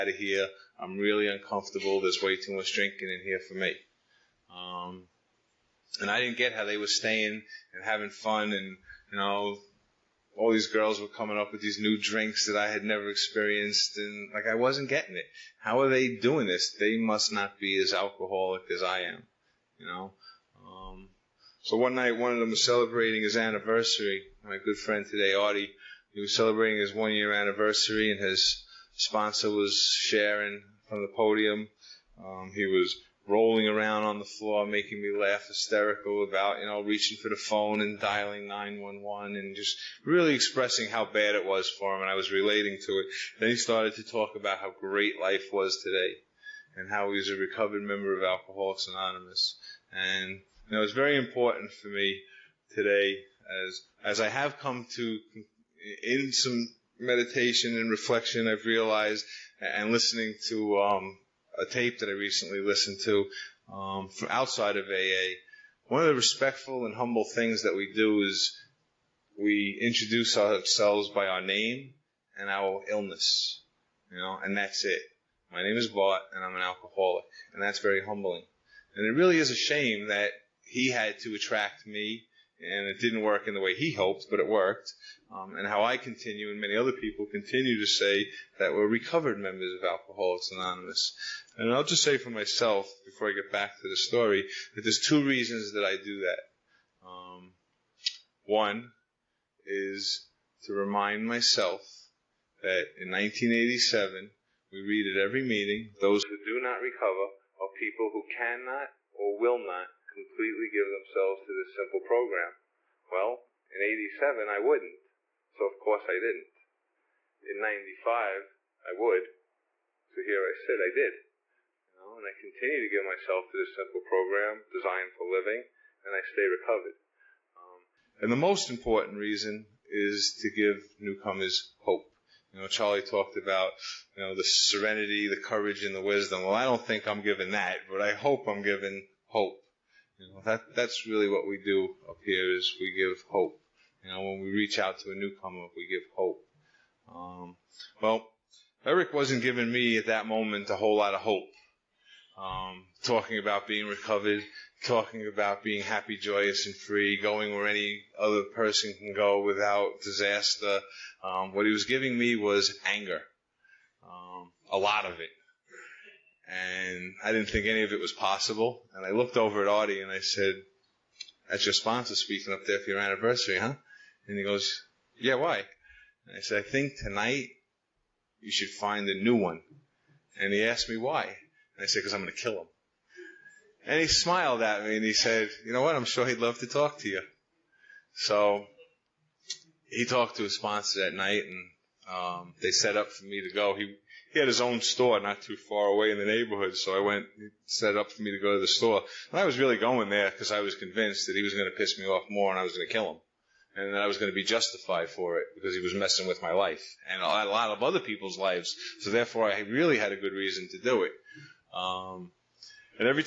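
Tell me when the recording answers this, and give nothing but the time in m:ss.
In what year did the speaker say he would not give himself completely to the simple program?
1:43.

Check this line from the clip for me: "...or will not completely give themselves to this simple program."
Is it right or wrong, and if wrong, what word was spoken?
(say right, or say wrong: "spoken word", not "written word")
right.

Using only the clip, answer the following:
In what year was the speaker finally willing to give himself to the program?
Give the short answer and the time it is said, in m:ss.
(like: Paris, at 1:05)
1995, at 1:57.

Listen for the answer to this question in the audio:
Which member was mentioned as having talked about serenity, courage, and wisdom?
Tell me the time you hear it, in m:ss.
2:12.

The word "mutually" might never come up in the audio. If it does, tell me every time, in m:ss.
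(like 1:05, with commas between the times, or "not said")
not said.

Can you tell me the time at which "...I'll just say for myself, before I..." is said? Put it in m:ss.
1:31.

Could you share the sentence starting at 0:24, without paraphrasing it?
My good friend today, Artie, he was celebrating his one-year anniversary, and his sponsor was sharing from the podium.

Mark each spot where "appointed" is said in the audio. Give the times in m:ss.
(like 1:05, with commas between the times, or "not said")
not said.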